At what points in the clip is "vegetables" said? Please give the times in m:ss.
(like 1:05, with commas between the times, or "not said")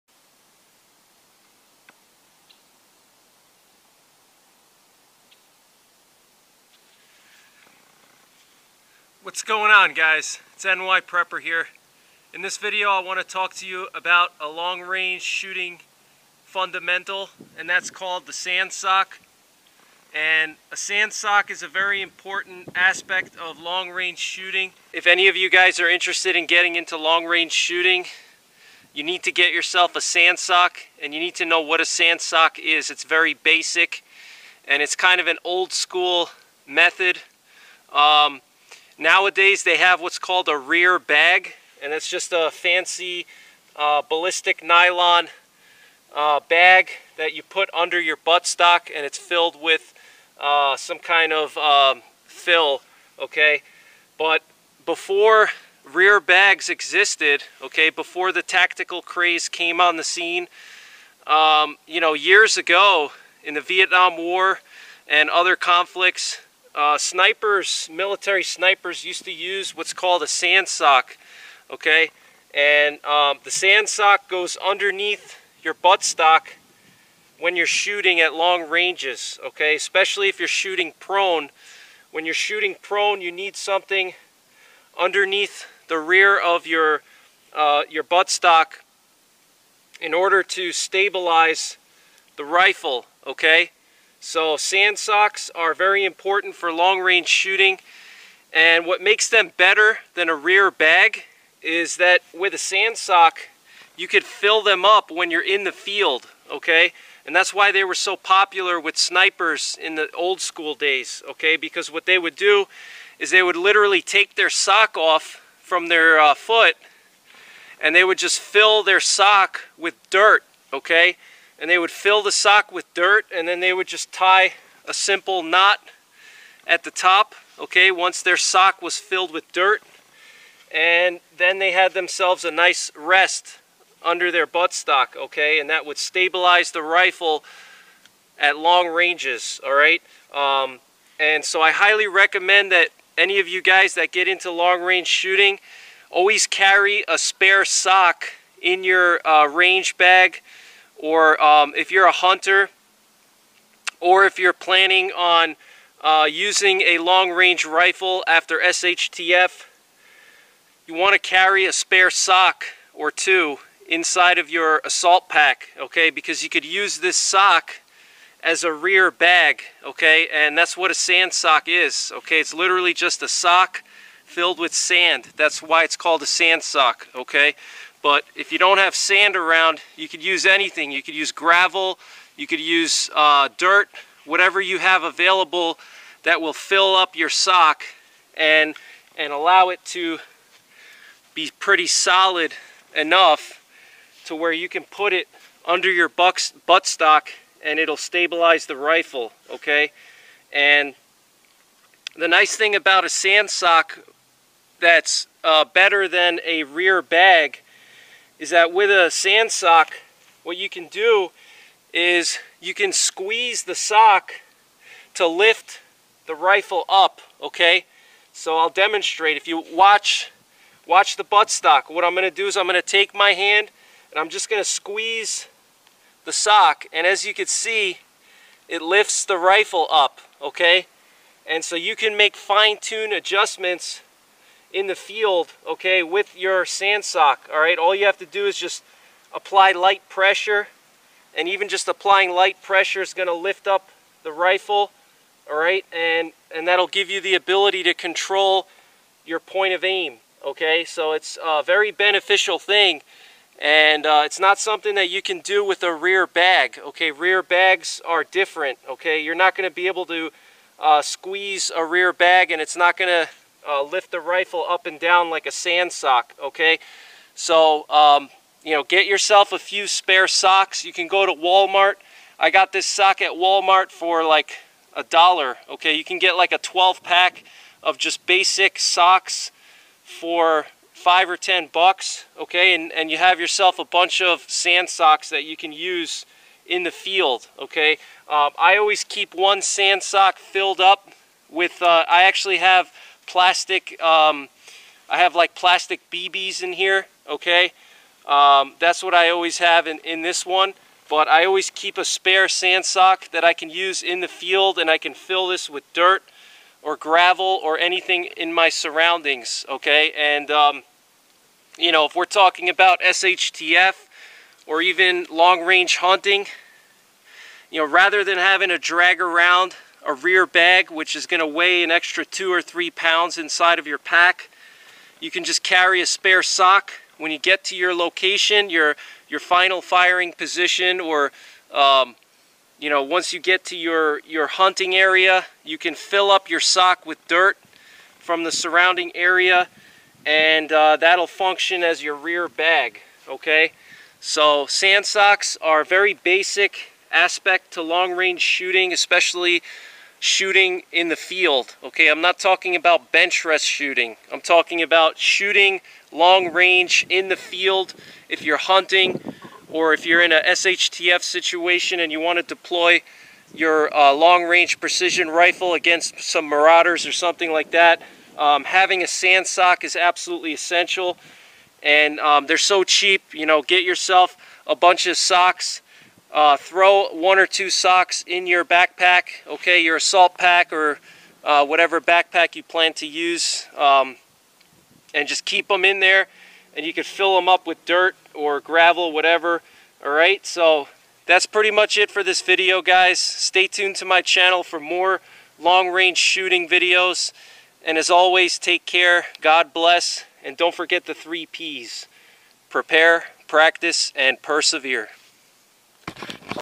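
not said.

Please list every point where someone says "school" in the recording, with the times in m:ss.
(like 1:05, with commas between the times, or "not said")
0:35, 1:50.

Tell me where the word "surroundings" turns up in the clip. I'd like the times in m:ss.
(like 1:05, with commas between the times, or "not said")
5:08, 5:38.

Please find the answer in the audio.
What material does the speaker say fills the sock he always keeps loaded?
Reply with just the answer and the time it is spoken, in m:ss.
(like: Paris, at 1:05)
plastic BBs, at 4:55.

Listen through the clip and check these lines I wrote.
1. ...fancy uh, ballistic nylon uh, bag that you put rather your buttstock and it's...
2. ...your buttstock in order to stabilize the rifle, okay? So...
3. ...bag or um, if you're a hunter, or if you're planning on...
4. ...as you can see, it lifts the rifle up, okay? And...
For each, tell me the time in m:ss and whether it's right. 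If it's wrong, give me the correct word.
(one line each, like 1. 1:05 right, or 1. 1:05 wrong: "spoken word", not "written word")
1. 0:42 wrong: "under", not "rather"
2. 1:27 right
3. 2:29 right
4. 3:47 right.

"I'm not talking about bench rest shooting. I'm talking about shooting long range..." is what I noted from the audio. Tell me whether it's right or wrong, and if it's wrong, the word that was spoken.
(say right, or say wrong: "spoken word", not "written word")
right.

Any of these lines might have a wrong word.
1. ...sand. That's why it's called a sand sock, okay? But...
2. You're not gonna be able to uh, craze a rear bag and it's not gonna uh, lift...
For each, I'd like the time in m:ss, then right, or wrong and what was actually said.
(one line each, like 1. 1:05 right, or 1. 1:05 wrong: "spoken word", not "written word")
1. 2:54 right
2. 4:19 wrong: "squeeze", not "craze".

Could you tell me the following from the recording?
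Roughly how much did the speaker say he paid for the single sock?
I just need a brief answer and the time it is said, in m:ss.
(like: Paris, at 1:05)
$1, at 4:34.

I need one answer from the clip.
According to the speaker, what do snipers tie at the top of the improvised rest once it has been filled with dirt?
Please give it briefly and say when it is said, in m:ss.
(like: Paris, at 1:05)
a simple knot, at 2:04.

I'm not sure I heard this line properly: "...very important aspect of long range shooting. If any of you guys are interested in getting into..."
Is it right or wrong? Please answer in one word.
right.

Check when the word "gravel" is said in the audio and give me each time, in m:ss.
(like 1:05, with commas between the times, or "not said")
3:01, 5:06, 6:28.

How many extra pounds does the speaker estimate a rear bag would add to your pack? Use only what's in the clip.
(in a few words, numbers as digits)
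2 or 3 pounds.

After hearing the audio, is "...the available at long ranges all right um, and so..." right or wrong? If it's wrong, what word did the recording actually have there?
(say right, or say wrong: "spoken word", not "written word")
wrong: "rifle", not "available".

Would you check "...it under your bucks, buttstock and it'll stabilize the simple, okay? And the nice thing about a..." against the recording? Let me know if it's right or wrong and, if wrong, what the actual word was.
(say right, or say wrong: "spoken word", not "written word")
wrong: "rifle", not "simple".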